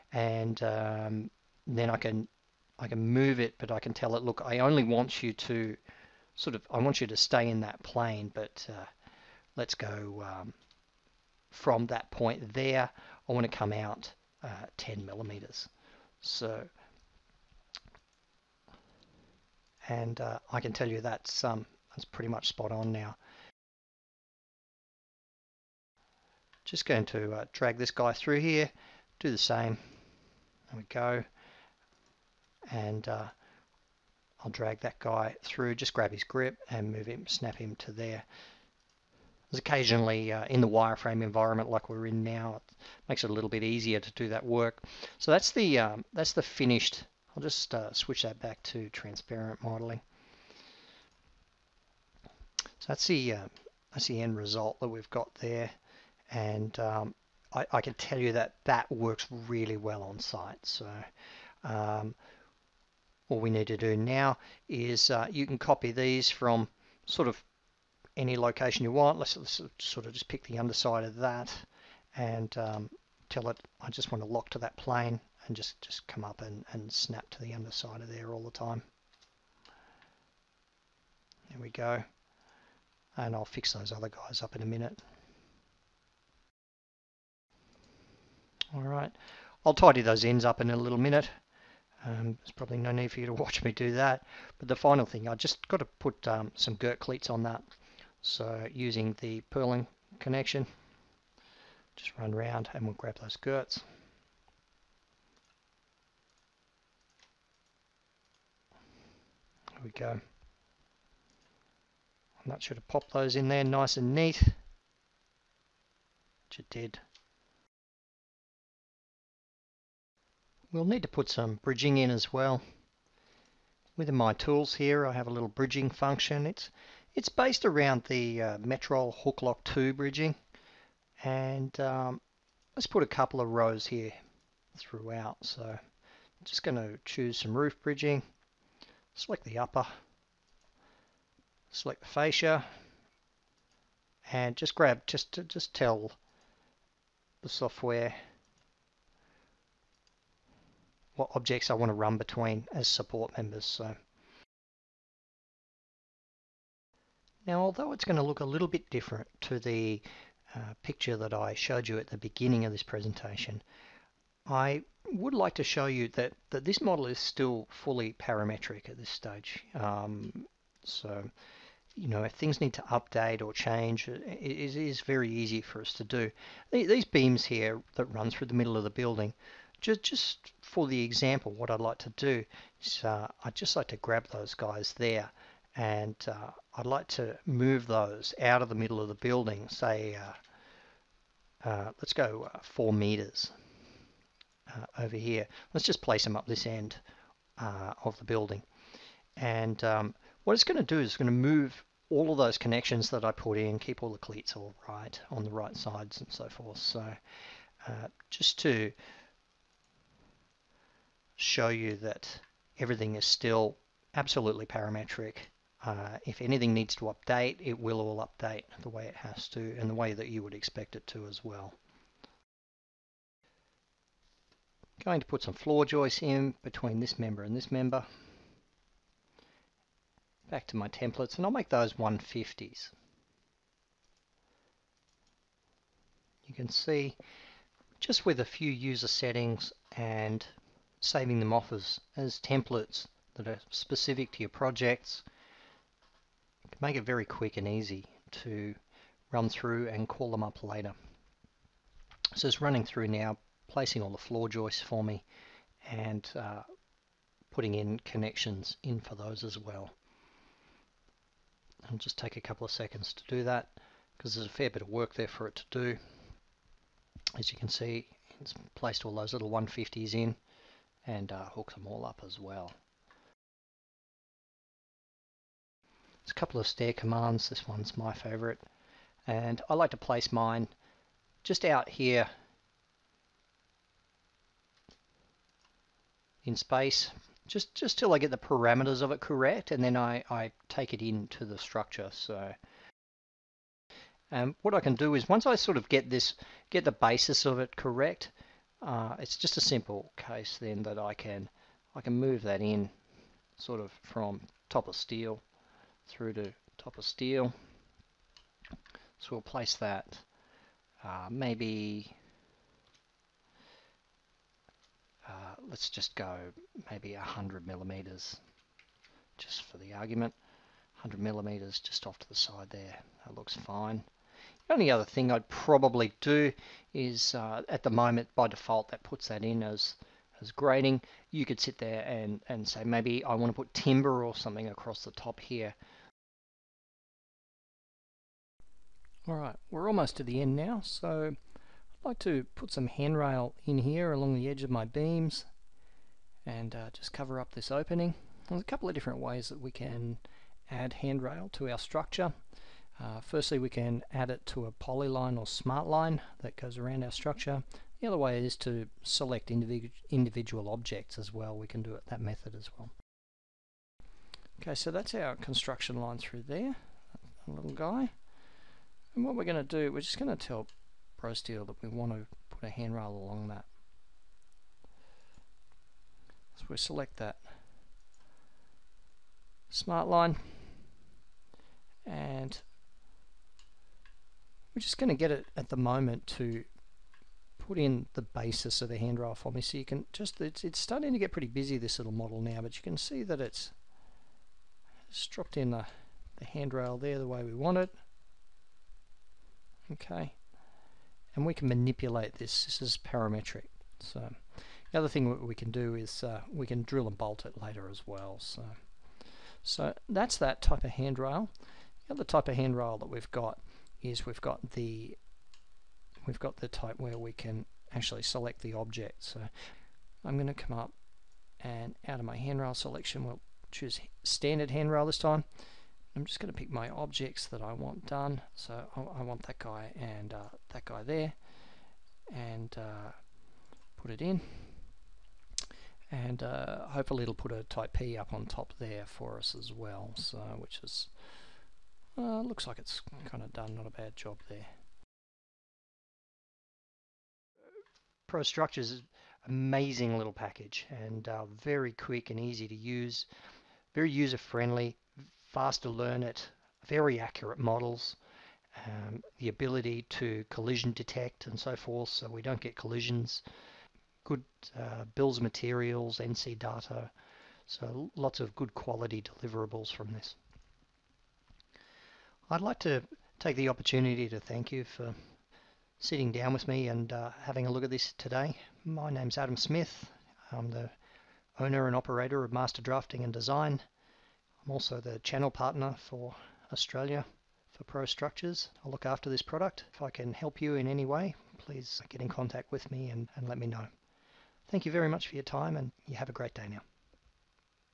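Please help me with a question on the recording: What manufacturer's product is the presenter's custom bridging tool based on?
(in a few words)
Metroll.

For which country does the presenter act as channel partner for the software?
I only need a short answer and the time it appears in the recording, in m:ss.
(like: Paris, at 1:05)
Australia, at 8:06.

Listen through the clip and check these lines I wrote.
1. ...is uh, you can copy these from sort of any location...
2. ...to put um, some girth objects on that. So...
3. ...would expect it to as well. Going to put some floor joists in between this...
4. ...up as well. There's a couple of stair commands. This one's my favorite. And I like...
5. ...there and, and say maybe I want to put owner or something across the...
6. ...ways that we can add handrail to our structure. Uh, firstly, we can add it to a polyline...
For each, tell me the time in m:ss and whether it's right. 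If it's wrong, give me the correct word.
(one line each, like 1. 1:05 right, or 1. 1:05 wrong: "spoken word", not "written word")
1. 1:04 right
2. 1:35 wrong: "cleats", not "objects"
3. 3:40 right
4. 4:32 right
5. 5:31 wrong: "timber", not "owner"
6. 5:49 right.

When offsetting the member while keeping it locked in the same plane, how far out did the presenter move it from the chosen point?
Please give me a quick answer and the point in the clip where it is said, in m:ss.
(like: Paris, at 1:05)
10 millimeters, at 0:14.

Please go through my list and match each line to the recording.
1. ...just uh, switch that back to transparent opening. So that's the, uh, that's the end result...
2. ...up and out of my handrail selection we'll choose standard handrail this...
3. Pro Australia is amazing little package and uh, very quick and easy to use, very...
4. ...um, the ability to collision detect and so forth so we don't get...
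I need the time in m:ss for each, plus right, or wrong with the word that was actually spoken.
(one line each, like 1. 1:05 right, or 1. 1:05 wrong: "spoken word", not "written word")
1. 0:47 wrong: "modeling", not "opening"
2. 7:00 right
3. 7:28 wrong: "Structures", not "Australia"
4. 7:38 right.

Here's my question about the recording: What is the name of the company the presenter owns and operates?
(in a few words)
Master Drafting and Design.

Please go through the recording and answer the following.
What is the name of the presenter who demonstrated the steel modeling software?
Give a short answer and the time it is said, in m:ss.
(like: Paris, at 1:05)
Adam Smith, at 7:59.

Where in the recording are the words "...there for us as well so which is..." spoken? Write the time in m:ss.
7:18.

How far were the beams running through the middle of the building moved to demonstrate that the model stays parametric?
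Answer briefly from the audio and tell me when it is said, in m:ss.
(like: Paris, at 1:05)
4 meters, at 3:12.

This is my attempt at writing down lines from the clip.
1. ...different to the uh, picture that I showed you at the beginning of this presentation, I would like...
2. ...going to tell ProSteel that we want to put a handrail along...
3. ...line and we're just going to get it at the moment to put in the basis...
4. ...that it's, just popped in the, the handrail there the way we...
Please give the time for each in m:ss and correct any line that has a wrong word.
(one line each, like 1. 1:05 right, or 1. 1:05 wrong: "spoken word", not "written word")
1. 2:38 right
2. 6:10 right
3. 6:20 right
4. 6:33 wrong: "dropped", not "popped".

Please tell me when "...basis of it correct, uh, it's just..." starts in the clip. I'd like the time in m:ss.
4:56.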